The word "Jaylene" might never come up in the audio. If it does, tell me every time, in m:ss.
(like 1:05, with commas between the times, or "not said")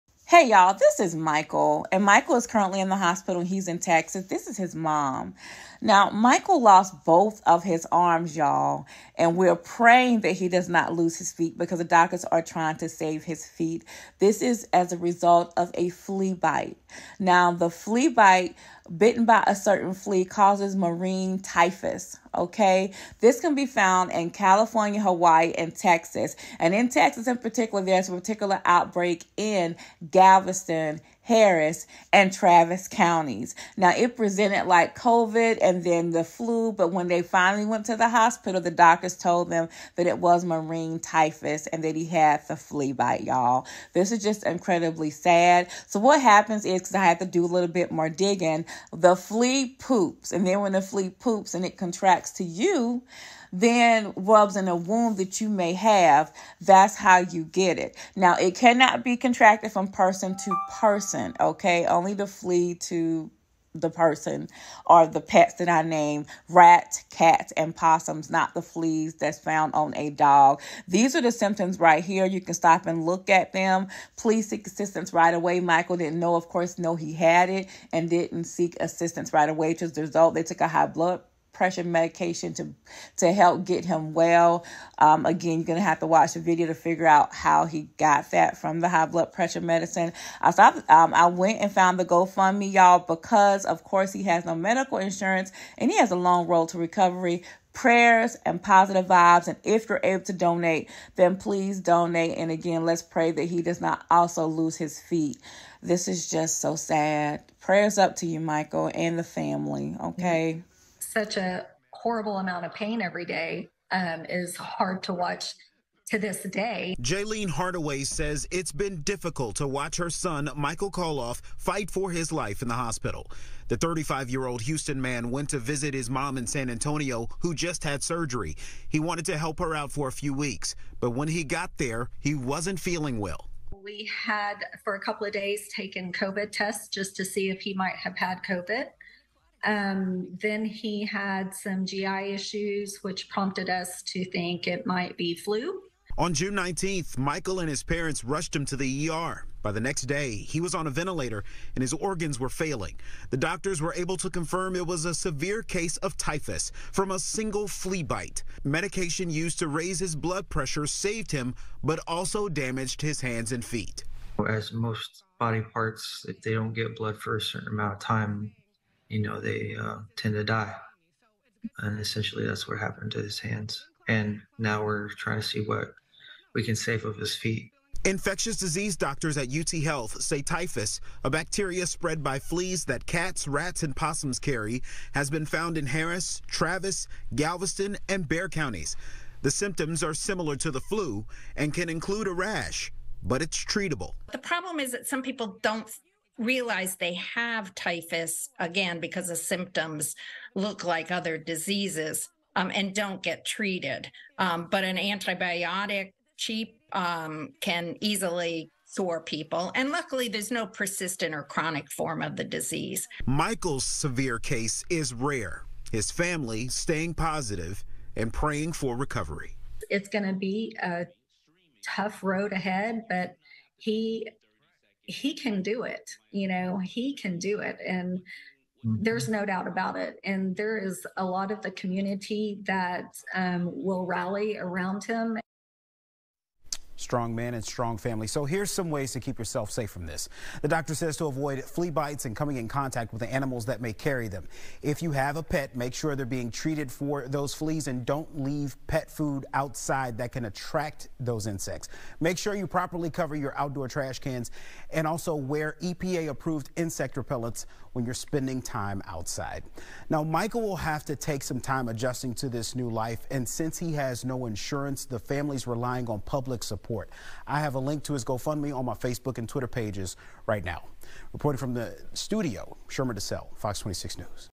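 1:57.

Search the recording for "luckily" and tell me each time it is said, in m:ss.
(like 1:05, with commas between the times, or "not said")
3:29.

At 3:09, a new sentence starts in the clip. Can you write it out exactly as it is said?
The symptoms are similar to the flu and can include a rash, but it's treatable.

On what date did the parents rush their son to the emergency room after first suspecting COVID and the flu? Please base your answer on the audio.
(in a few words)
June 19.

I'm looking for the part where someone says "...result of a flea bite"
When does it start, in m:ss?
0:14.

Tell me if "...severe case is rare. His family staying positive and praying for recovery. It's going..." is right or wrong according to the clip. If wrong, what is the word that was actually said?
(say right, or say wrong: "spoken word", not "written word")
right.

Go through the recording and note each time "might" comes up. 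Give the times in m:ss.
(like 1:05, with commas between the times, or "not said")
2:17, 2:24.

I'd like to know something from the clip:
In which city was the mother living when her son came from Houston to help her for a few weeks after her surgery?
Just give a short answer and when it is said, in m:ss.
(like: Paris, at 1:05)
San Antonio, at 2:06.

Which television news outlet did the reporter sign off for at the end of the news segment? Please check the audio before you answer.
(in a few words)
Fox 26 News.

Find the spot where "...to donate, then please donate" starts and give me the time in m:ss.
1:40.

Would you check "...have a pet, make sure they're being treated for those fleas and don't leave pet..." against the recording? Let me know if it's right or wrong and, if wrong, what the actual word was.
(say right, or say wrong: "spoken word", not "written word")
right.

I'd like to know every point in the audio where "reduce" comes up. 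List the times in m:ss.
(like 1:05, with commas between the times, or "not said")
not said.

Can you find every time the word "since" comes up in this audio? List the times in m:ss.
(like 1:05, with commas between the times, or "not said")
4:23.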